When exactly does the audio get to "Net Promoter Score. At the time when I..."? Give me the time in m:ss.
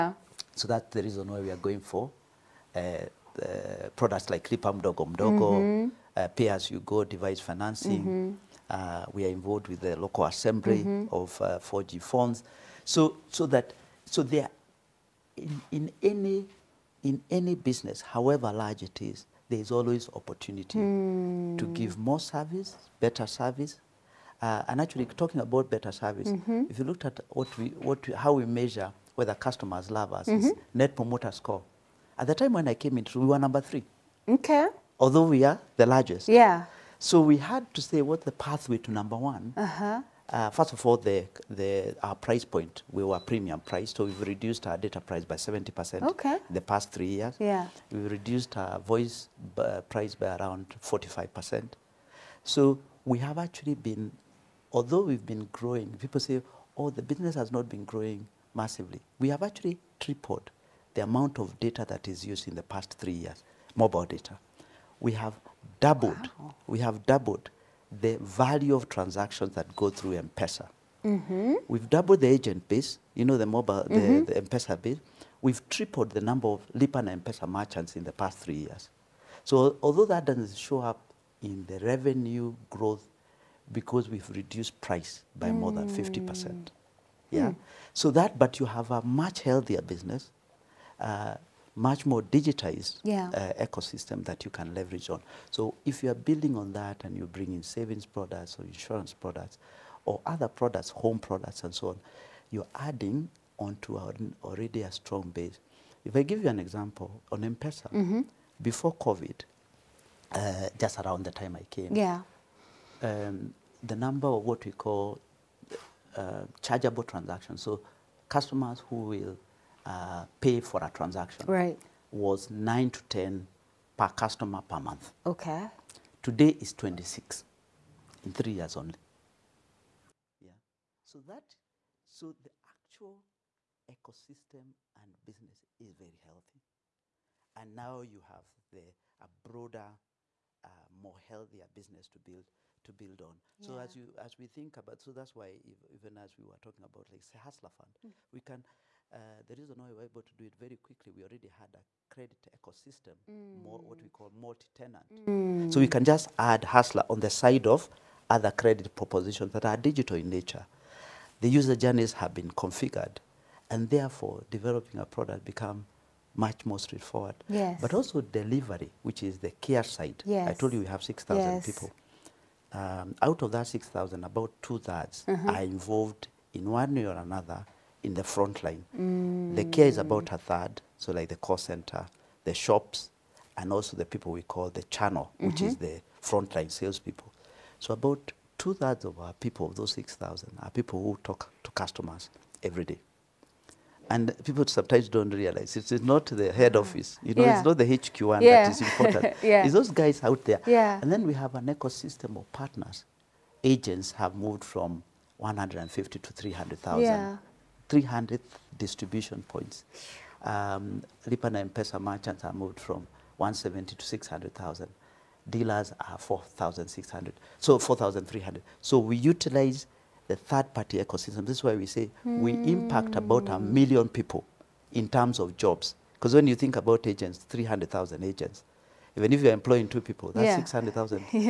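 0:30.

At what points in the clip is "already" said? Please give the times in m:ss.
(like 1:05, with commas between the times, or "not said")
1:44, 2:31.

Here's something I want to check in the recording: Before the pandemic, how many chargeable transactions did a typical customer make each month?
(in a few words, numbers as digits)
9 to 10.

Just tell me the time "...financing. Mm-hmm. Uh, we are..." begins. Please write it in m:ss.
0:07.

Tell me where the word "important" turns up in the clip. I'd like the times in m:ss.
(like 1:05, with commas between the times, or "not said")
3:18.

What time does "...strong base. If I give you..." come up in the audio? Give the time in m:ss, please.
1:44.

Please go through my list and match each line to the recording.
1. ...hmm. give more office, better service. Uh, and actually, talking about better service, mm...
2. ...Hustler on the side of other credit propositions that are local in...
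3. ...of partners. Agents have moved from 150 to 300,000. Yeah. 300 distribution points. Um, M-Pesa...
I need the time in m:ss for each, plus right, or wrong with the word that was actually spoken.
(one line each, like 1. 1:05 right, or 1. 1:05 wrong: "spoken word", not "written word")
1. 0:21 wrong: "service", not "office"
2. 2:36 wrong: "digital", not "local"
3. 3:22 right.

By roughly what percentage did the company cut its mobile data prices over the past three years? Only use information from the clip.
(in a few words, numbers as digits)
70%.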